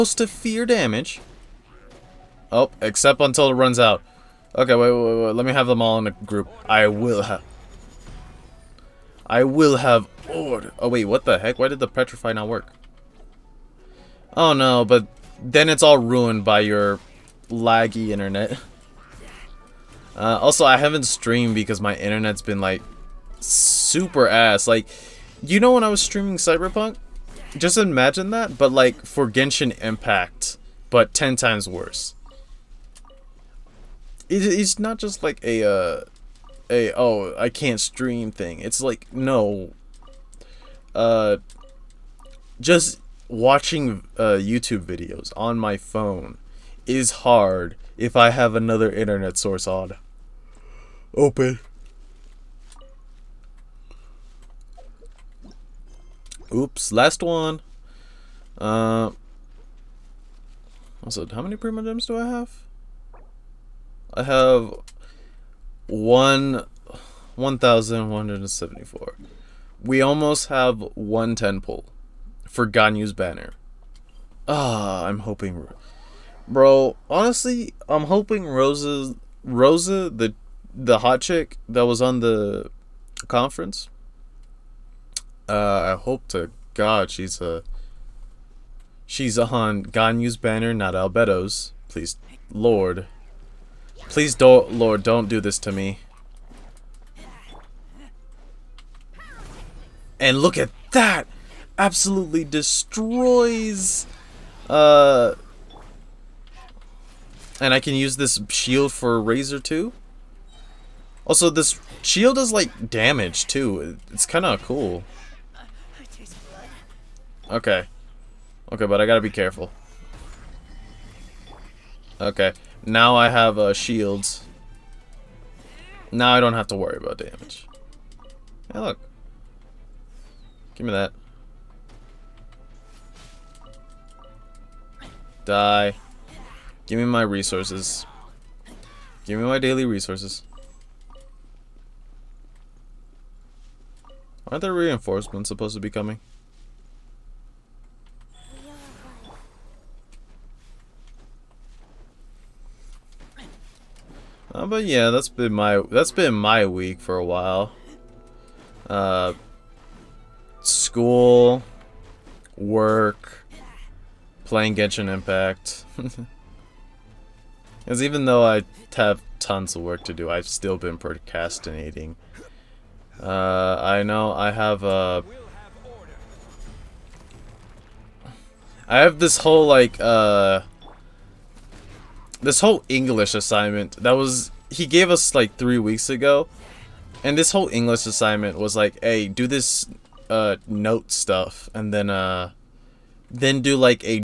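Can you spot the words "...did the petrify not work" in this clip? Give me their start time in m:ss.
0:11.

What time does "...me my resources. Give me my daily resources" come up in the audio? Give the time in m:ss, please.
2:16.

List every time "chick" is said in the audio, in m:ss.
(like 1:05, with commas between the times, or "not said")
1:21.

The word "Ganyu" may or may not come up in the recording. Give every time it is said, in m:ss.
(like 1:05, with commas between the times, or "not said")
1:12, 1:29.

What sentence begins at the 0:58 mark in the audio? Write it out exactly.
Uh, also, how many Primogems do I have?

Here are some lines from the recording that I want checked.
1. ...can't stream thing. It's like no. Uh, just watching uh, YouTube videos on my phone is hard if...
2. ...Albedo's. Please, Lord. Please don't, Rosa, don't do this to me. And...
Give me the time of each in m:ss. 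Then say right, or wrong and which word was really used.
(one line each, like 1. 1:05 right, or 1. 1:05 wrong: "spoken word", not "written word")
1. 0:37 right
2. 1:30 wrong: "Lord", not "Rosa".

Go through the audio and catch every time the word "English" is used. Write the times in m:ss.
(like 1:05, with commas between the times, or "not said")
3:02, 3:07.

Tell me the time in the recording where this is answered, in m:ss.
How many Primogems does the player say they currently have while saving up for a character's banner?
1:07.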